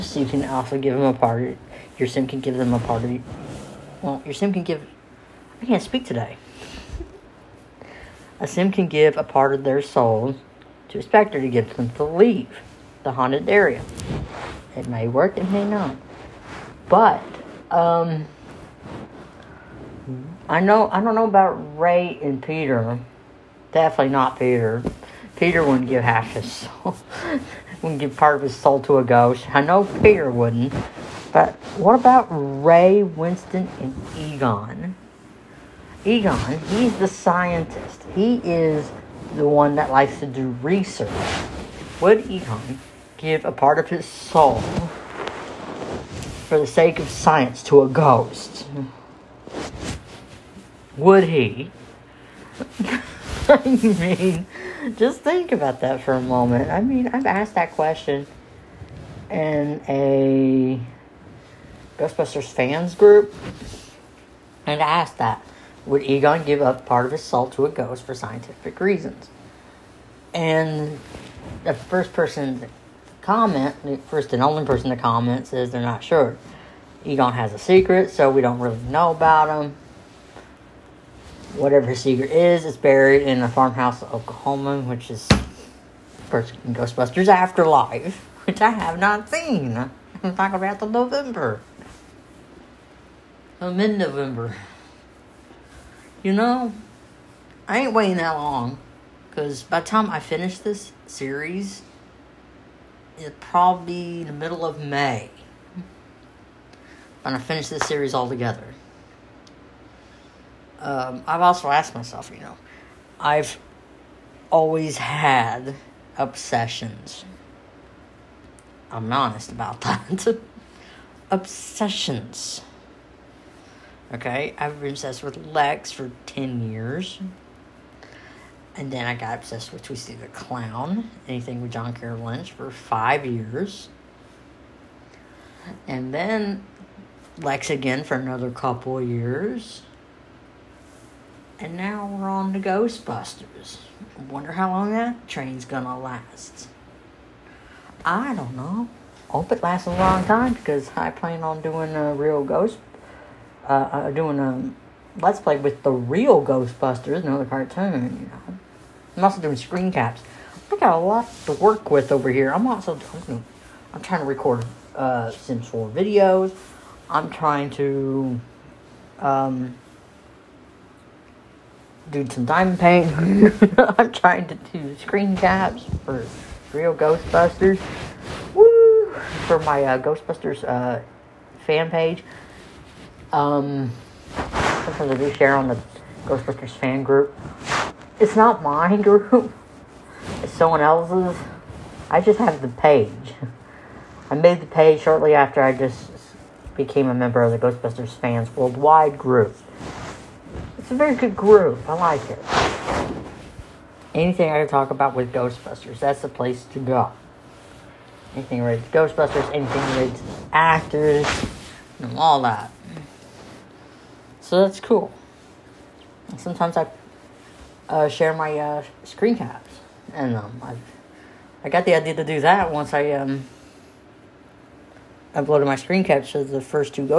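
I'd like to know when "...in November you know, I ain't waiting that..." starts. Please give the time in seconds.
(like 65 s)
93 s.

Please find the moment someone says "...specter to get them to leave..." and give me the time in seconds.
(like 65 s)
11 s.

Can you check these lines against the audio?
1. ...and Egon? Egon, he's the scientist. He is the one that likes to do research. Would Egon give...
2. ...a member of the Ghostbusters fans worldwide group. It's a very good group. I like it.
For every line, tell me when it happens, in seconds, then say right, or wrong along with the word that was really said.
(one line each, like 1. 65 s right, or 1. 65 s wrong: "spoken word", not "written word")
1. 33 s right
2. 197 s right.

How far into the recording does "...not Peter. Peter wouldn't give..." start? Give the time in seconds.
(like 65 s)
24 s.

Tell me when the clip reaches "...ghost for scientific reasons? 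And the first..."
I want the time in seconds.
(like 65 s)
67 s.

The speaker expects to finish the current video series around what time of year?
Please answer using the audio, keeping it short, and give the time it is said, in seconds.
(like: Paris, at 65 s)
Middle of May, at 104 s.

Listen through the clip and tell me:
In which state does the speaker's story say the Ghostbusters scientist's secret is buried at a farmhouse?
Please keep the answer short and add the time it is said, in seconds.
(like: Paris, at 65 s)
Oklahoma, at 84 s.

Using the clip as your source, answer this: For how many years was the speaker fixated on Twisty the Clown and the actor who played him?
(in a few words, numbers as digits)
5.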